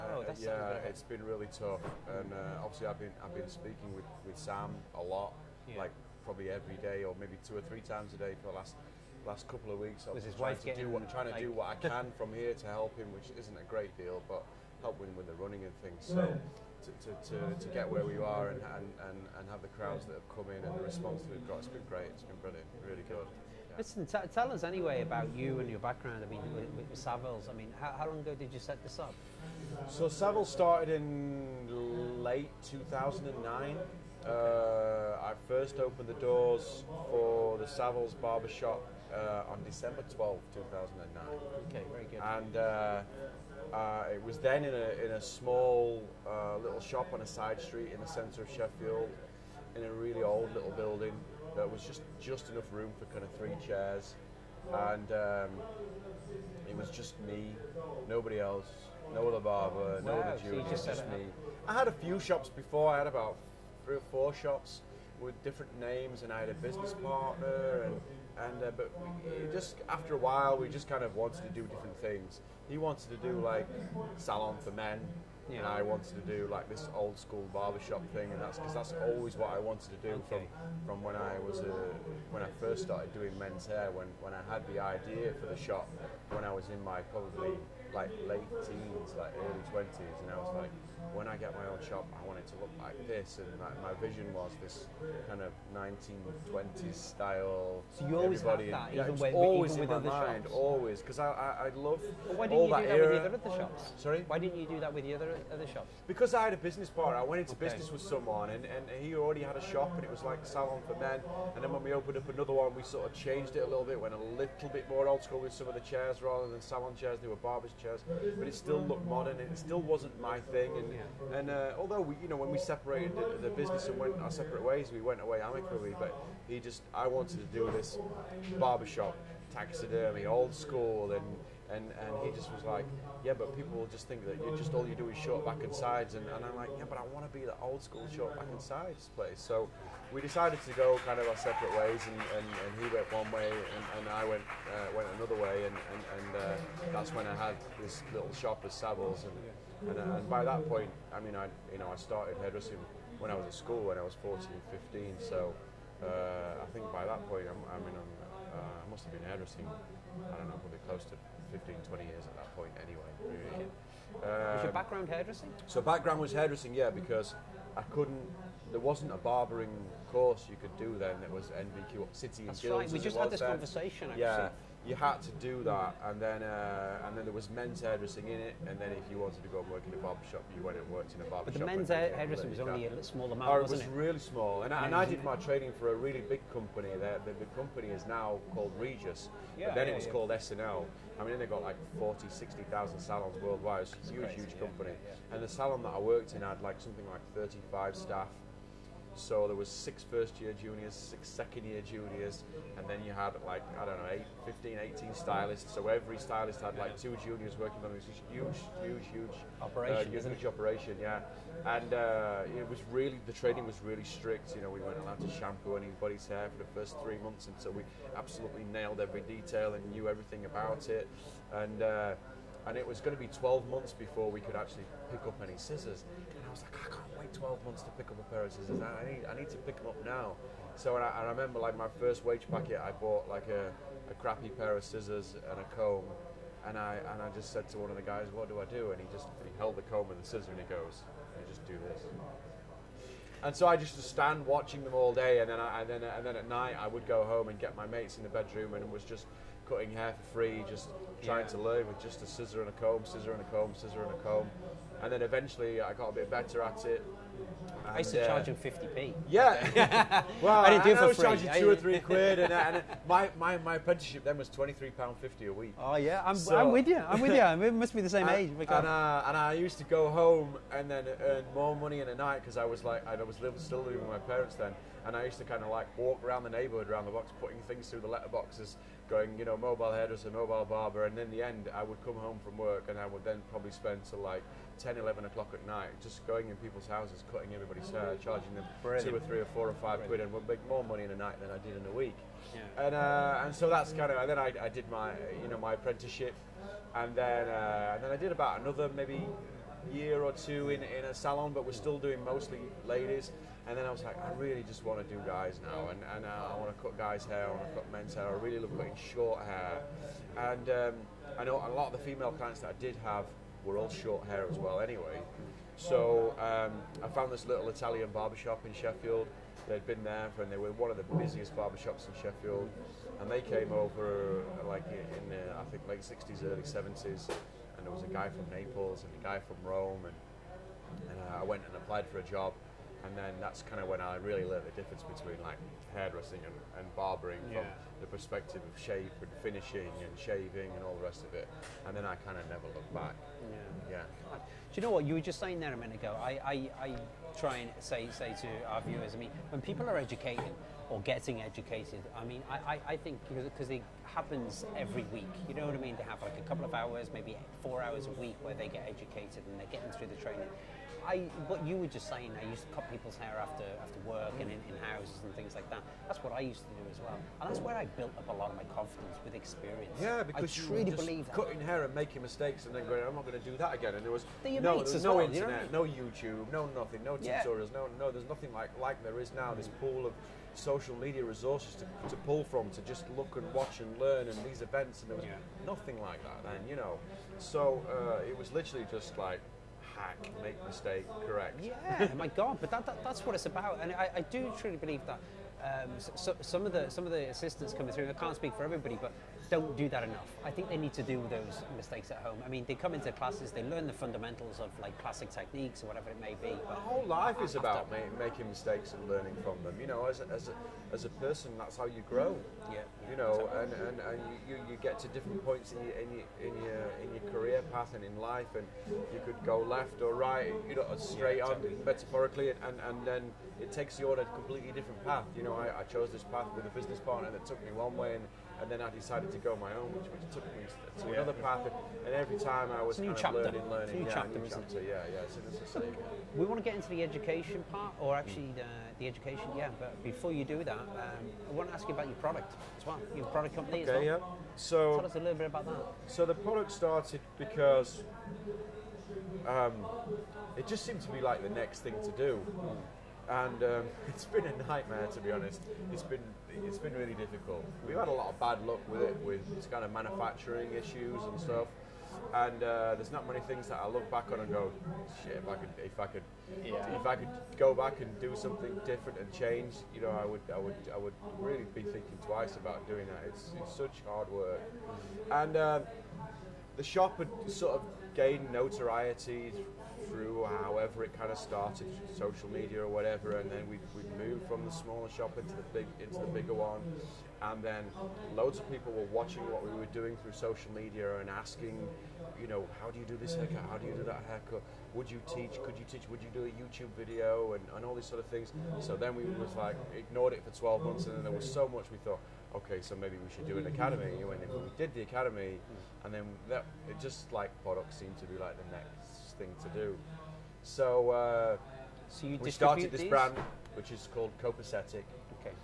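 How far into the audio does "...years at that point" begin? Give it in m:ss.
2:42.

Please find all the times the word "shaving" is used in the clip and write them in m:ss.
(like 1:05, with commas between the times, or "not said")
5:40.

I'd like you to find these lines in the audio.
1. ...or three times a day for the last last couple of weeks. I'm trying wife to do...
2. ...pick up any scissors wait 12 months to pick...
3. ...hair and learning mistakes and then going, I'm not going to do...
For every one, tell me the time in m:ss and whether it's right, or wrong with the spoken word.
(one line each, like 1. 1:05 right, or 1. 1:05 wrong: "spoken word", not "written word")
1. 0:07 right
2. 3:45 right
3. 6:11 wrong: "making", not "learning".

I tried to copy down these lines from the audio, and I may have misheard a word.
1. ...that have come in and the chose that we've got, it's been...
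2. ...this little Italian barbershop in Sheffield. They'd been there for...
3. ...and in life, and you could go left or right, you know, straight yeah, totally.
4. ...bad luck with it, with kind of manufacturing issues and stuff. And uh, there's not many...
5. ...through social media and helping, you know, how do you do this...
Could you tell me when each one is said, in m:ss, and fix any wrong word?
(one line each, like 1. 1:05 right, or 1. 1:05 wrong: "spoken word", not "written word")
1. 0:20 wrong: "response", not "chose"
2. 5:17 right
3. 6:57 right
4. 7:38 right
5. 8:10 wrong: "asking", not "helping".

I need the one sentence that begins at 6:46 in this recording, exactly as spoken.
But whole life is about ma- making mistakes and learning from them.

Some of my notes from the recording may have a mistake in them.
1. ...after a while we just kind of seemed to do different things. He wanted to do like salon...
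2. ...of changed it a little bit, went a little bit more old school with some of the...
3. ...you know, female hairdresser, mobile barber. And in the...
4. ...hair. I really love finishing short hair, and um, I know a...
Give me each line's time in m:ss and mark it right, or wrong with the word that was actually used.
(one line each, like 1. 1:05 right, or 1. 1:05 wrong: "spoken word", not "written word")
1. 1:09 wrong: "wanted", not "seemed"
2. 1:53 right
3. 4:39 wrong: "mobile", not "female"
4. 5:08 wrong: "cutting", not "finishing".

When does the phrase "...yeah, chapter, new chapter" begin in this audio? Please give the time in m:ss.
7:14.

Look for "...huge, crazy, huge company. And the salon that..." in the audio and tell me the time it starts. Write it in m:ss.
3:14.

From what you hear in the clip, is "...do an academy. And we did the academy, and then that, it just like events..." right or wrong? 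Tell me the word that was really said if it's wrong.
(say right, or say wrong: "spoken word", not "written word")
wrong: "products", not "events".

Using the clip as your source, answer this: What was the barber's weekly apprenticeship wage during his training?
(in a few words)
£23.50.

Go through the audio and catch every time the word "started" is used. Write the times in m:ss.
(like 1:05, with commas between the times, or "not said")
0:30, 1:22, 2:31, 7:26, 8:01, 8:32.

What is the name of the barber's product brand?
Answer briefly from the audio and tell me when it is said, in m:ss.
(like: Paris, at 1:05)
Copacetic, at 8:34.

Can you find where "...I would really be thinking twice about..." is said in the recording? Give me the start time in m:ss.
7:50.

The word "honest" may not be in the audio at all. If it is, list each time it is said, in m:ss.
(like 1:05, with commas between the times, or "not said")
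7:35.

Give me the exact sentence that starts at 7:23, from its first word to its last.
Your product company okay, as well.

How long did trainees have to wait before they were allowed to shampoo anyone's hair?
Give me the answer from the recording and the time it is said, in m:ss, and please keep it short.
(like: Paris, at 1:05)
3 months, at 3:37.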